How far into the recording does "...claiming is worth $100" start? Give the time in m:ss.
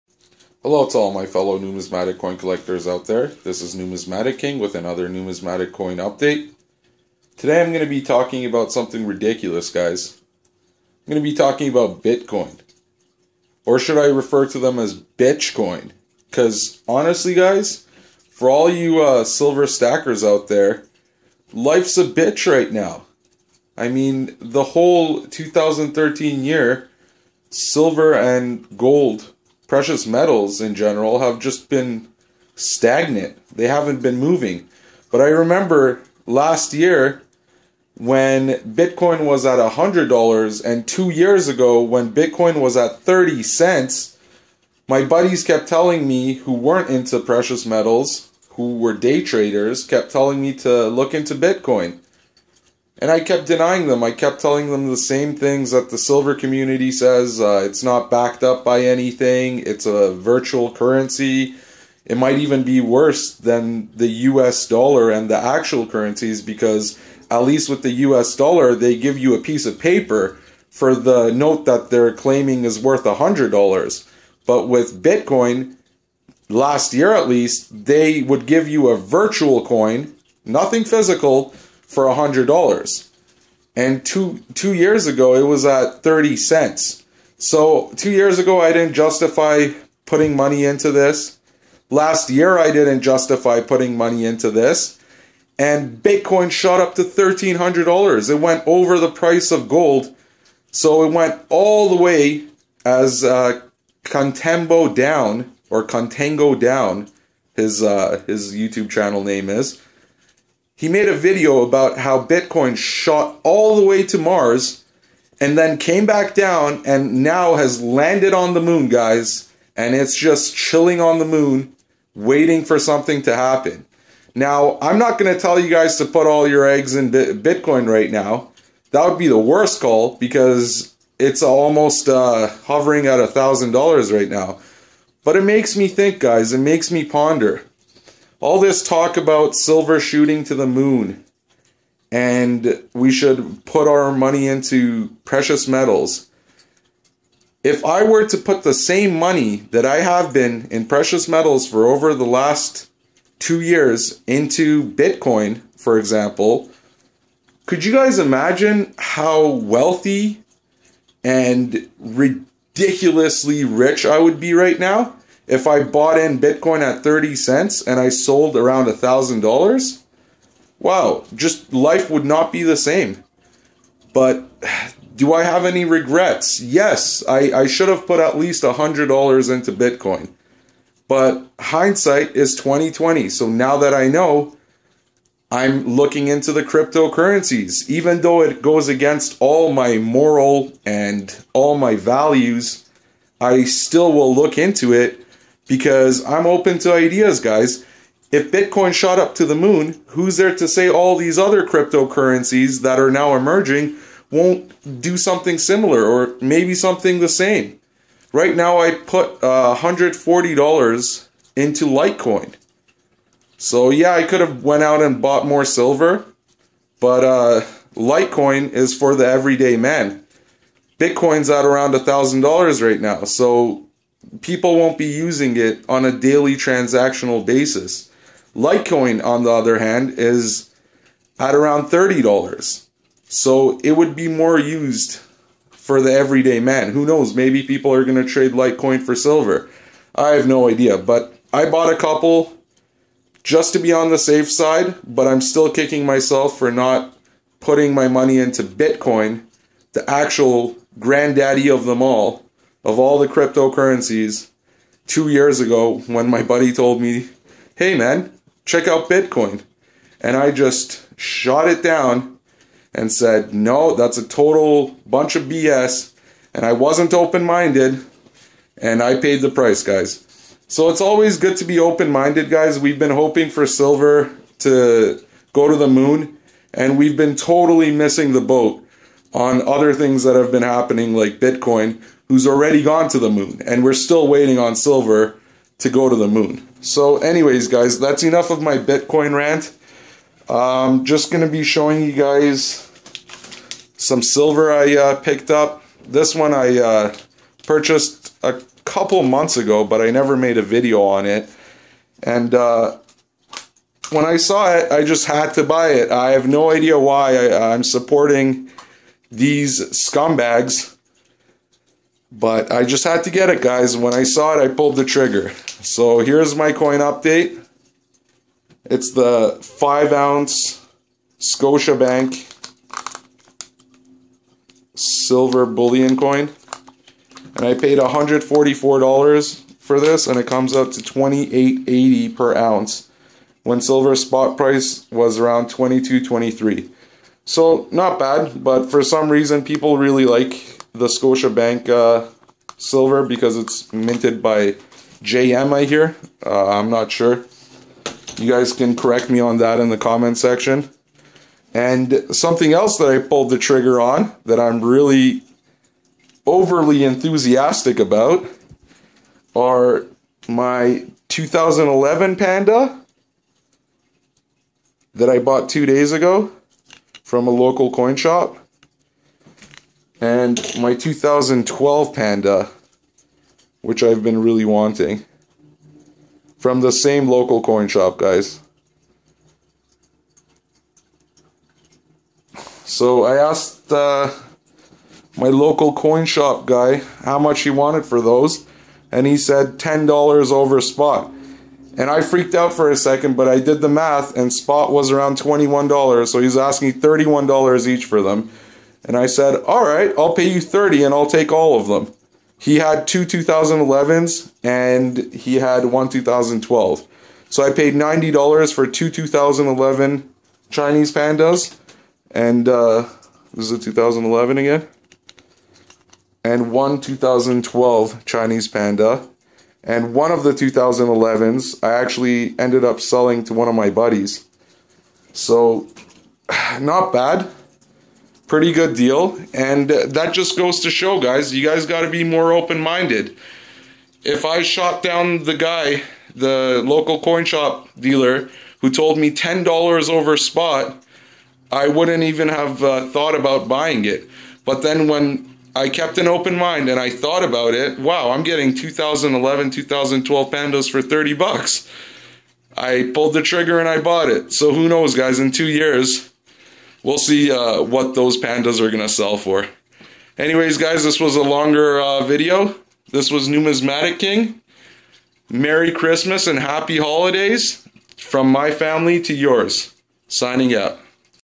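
1:12.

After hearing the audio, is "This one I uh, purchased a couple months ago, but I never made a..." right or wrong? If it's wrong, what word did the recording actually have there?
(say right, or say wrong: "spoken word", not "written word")
right.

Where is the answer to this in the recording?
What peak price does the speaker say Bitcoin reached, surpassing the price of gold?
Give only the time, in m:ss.
1:37.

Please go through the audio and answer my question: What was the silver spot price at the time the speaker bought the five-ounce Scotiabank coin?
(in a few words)
22.23.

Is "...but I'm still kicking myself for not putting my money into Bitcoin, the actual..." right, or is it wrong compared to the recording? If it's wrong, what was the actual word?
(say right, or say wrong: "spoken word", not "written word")
right.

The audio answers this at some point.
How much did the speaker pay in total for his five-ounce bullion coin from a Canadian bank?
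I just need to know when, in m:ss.
5:27.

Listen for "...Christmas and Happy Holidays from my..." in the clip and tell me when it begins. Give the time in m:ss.
7:45.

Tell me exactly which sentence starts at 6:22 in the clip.
So I asked uh, my local coin shop guy how much he wanted for those, and he said $10 over spot.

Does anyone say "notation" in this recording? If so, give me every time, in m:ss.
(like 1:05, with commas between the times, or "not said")
not said.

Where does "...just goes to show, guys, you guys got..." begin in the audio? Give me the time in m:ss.
7:10.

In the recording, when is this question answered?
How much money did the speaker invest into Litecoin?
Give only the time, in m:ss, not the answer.
3:29.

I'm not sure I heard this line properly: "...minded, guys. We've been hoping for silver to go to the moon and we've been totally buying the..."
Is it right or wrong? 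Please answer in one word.
wrong.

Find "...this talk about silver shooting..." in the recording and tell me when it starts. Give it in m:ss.
2:18.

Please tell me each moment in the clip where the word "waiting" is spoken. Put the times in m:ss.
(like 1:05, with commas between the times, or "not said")
2:02, 4:44.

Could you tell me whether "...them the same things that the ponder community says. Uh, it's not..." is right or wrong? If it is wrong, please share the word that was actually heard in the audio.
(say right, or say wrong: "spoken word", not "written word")
wrong: "silver", not "ponder".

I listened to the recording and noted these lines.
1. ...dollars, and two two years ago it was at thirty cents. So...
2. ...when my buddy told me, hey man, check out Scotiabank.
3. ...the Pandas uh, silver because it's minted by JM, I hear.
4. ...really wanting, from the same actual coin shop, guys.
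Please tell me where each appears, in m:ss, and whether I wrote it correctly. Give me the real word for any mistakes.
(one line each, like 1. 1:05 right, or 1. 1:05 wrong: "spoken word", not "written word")
1. 1:22 right
2. 4:16 wrong: "Bitcoin", not "Scotiabank"
3. 5:41 wrong: "Scotiabank", not "Pandas"
4. 6:14 wrong: "local", not "actual".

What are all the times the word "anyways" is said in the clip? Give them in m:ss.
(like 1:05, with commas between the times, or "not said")
4:47, 7:40.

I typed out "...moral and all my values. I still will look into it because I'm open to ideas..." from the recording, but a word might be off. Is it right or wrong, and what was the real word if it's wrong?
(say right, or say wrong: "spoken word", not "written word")
right.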